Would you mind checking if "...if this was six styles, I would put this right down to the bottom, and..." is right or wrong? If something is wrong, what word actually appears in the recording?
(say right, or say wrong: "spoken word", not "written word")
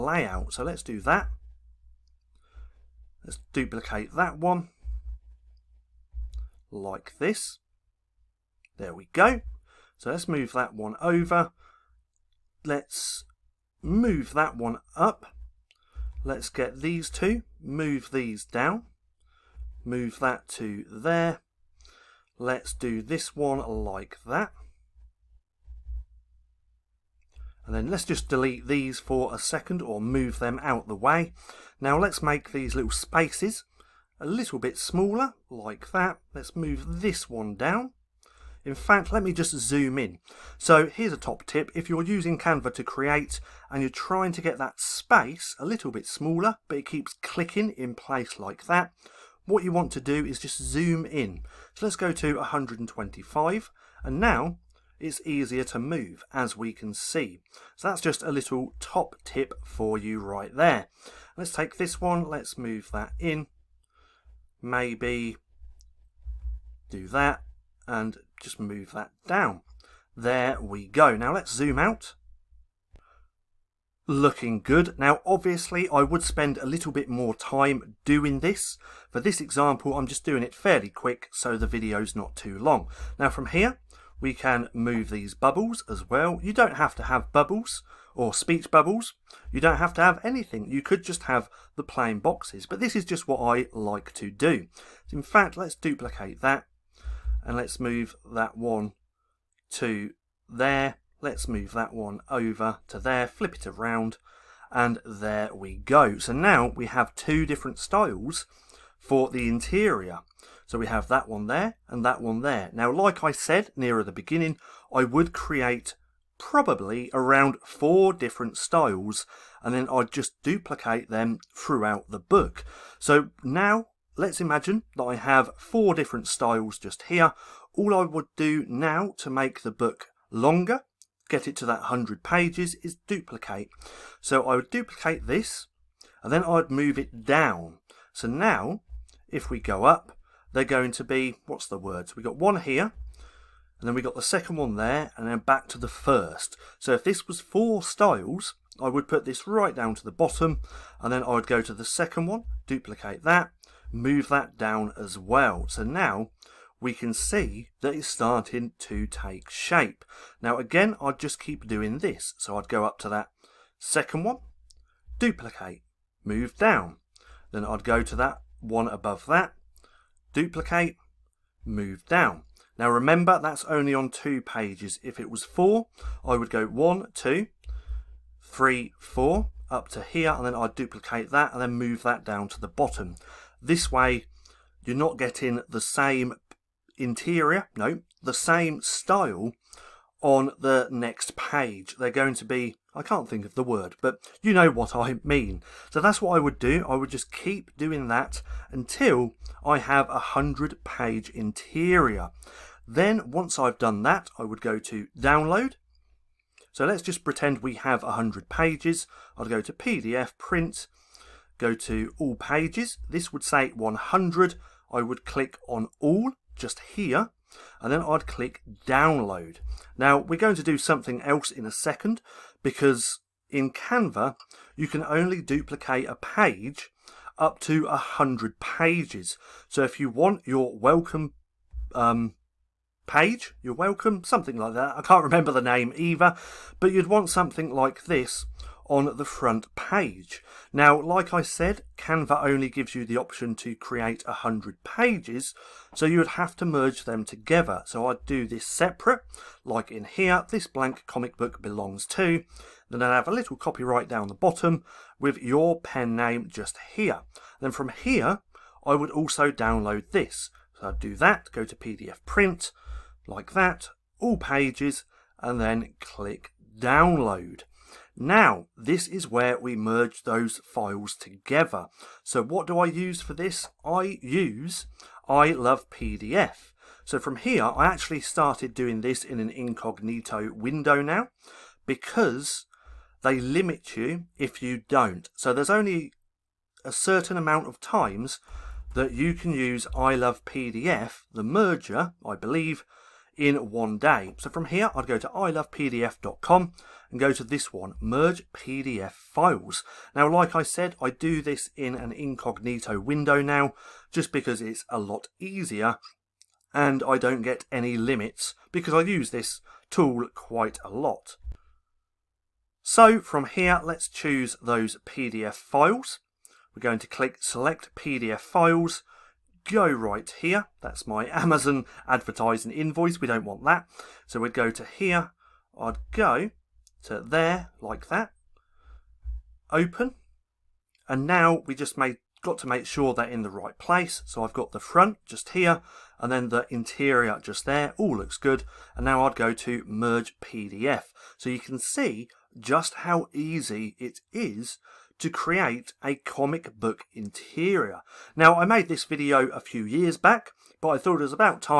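wrong: "four", not "six".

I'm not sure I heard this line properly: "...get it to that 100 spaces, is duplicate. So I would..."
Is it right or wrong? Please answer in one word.
wrong.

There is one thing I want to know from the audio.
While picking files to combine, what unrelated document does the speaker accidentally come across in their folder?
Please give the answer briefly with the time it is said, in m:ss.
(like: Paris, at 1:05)
Amazon advertising invoice, at 5:21.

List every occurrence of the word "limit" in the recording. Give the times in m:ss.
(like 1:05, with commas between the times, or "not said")
4:43, 5:07.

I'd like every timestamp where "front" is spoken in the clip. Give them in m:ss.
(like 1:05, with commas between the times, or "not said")
3:59, 5:34.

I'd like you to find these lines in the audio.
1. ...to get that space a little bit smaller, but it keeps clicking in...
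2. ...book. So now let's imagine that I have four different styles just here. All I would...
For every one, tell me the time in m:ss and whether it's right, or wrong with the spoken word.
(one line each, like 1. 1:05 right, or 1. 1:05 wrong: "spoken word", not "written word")
1. 0:44 right
2. 2:02 right.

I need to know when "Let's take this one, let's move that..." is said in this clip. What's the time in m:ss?
1:01.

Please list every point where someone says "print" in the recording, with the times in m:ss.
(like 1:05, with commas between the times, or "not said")
3:30, 4:22.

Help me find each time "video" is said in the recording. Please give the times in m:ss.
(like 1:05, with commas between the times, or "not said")
1:21, 5:49.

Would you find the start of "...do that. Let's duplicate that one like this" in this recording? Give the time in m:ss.
0:00.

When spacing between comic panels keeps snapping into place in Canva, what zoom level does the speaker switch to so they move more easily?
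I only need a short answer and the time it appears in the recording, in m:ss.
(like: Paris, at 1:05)
125, at 0:52.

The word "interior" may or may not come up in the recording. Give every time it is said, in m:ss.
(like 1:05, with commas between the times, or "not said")
1:49, 3:06, 3:21, 5:36, 5:47.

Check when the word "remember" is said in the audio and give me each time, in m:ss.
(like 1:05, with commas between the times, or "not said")
2:52, 3:55.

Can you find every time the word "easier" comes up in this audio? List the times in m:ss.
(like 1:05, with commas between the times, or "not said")
0:55, 5:05.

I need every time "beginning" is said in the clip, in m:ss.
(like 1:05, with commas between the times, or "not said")
1:54.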